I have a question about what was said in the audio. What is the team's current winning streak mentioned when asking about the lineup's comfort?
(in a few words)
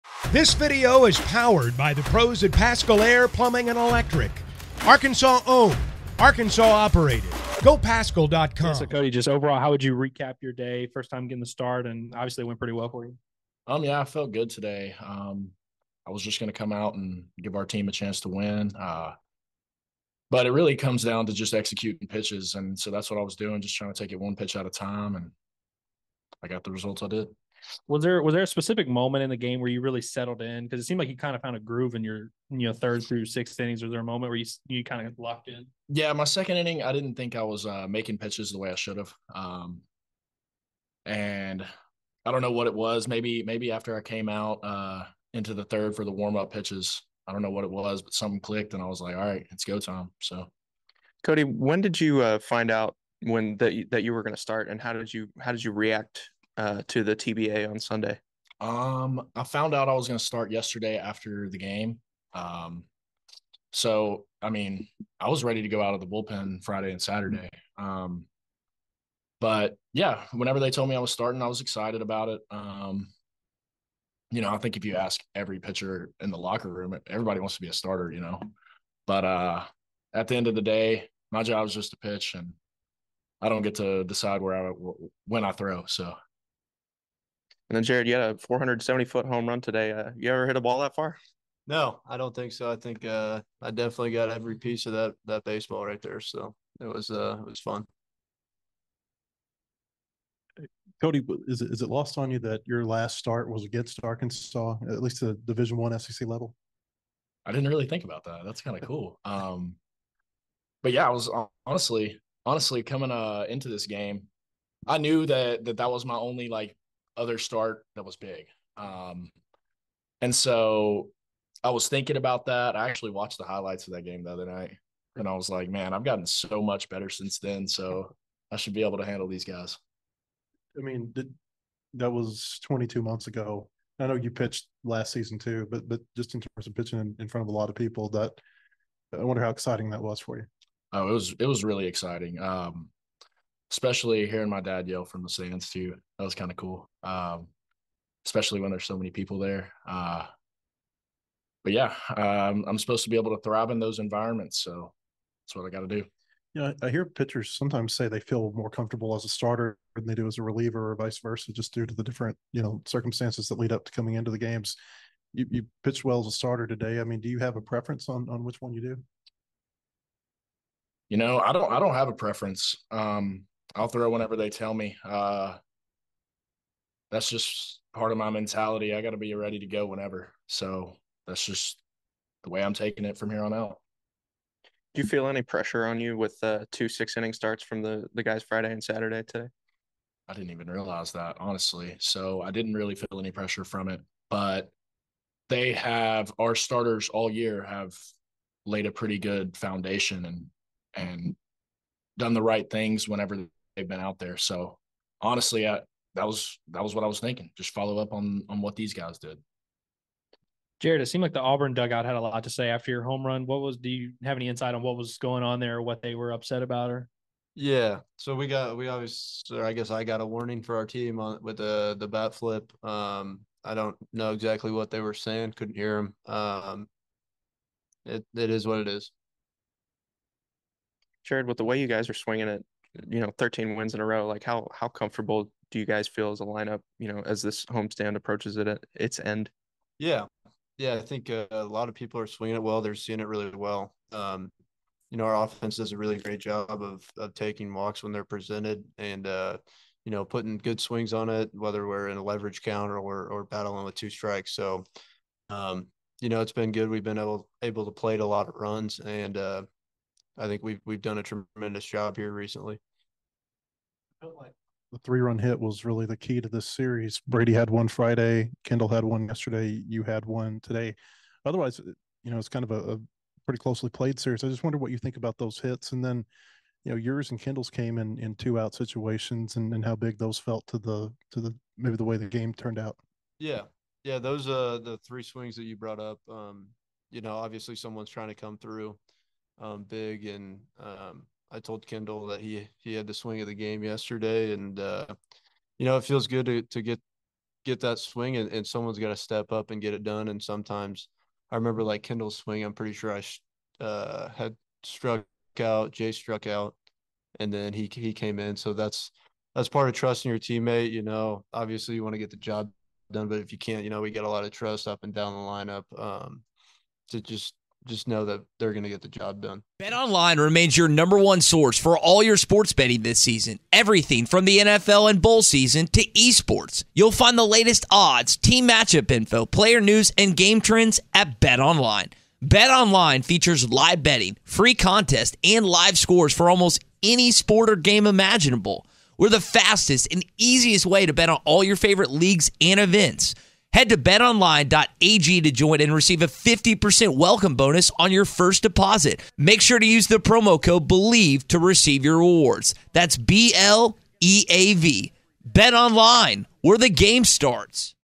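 13 wins.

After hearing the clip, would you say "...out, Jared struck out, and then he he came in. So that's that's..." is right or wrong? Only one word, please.
wrong.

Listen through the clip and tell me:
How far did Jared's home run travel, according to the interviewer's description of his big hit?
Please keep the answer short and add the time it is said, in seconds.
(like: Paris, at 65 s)
470 feet, at 88 s.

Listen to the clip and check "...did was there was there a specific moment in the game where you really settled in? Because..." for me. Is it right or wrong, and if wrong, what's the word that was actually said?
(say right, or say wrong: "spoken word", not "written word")
right.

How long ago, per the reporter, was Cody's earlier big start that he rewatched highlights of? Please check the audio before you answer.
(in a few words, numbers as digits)
22 months.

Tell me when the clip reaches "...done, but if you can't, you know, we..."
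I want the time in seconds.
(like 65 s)
313 s.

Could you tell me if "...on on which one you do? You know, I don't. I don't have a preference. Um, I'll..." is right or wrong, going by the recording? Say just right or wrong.
right.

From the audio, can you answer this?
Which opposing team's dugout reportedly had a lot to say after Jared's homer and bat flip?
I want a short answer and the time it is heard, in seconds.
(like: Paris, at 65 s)
Auburn, at 211 s.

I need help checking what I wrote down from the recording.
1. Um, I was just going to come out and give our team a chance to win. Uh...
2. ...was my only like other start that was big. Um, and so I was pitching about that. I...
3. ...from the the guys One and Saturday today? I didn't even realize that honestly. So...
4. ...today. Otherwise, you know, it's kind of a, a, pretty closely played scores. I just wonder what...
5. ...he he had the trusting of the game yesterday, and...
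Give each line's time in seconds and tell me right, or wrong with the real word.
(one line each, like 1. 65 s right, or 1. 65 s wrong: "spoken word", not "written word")
1. 15 s right
2. 115 s wrong: "thinking", not "pitching"
3. 187 s wrong: "Friday", not "One"
4. 270 s wrong: "series", not "scores"
5. 292 s wrong: "swing", not "trusting".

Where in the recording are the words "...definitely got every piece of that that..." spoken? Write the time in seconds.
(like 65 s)
93 s.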